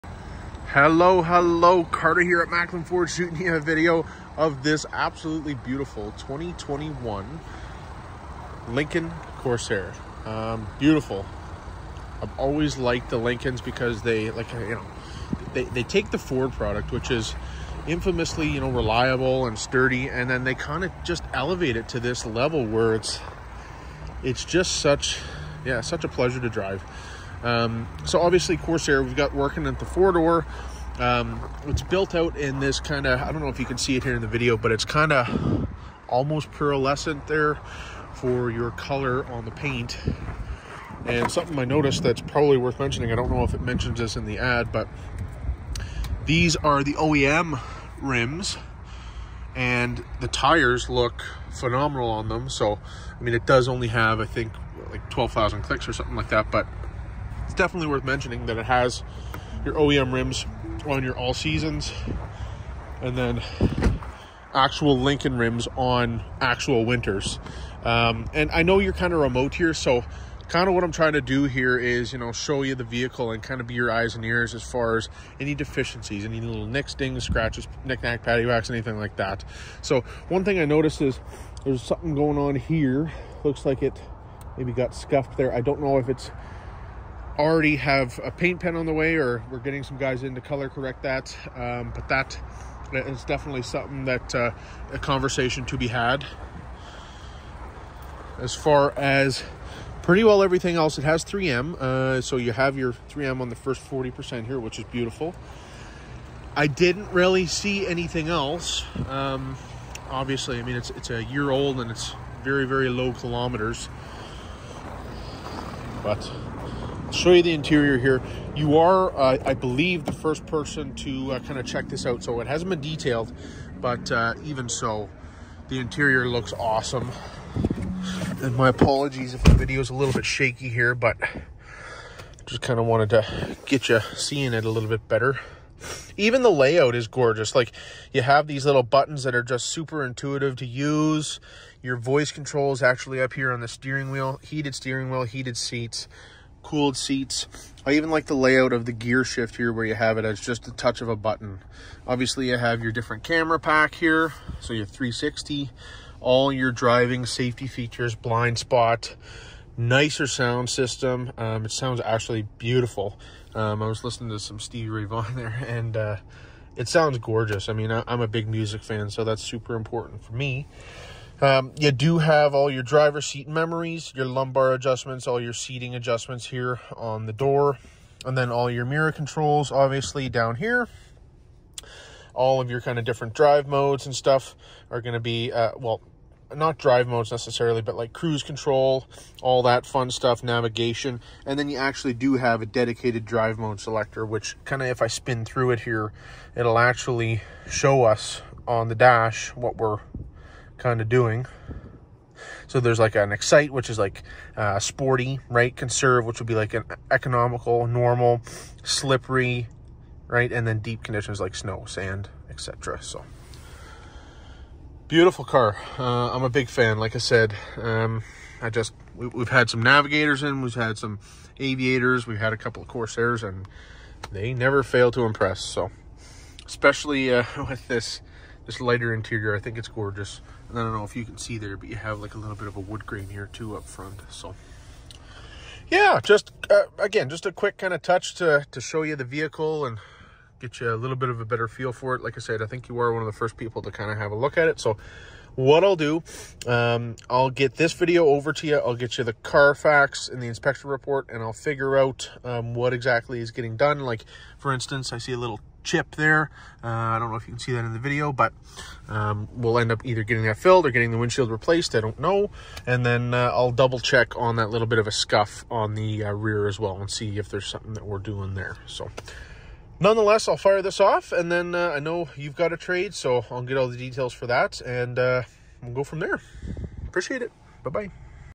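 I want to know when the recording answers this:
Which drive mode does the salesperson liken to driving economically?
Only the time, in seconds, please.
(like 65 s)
205 s.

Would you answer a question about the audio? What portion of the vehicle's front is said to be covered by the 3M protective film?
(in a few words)
40%.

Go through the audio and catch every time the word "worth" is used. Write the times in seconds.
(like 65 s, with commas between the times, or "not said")
42 s, 57 s.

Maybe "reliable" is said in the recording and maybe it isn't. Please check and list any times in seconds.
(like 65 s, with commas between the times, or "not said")
18 s.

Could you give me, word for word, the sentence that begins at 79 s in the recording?
So one thing I noticed is there's something going on here.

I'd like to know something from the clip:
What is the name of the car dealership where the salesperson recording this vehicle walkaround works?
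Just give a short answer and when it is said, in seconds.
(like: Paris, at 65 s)
Maclin Ford, at 2 s.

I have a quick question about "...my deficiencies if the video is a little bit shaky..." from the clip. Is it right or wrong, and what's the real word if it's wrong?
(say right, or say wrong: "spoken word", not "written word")
wrong: "apologies", not "deficiencies".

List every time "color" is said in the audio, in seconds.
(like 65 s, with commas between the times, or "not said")
38 s, 90 s.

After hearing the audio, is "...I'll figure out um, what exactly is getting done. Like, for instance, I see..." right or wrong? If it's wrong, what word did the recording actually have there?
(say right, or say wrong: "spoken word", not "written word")
right.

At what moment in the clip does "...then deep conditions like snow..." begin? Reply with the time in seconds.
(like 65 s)
210 s.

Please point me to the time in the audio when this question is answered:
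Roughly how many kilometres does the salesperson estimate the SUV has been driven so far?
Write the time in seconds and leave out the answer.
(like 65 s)
55 s.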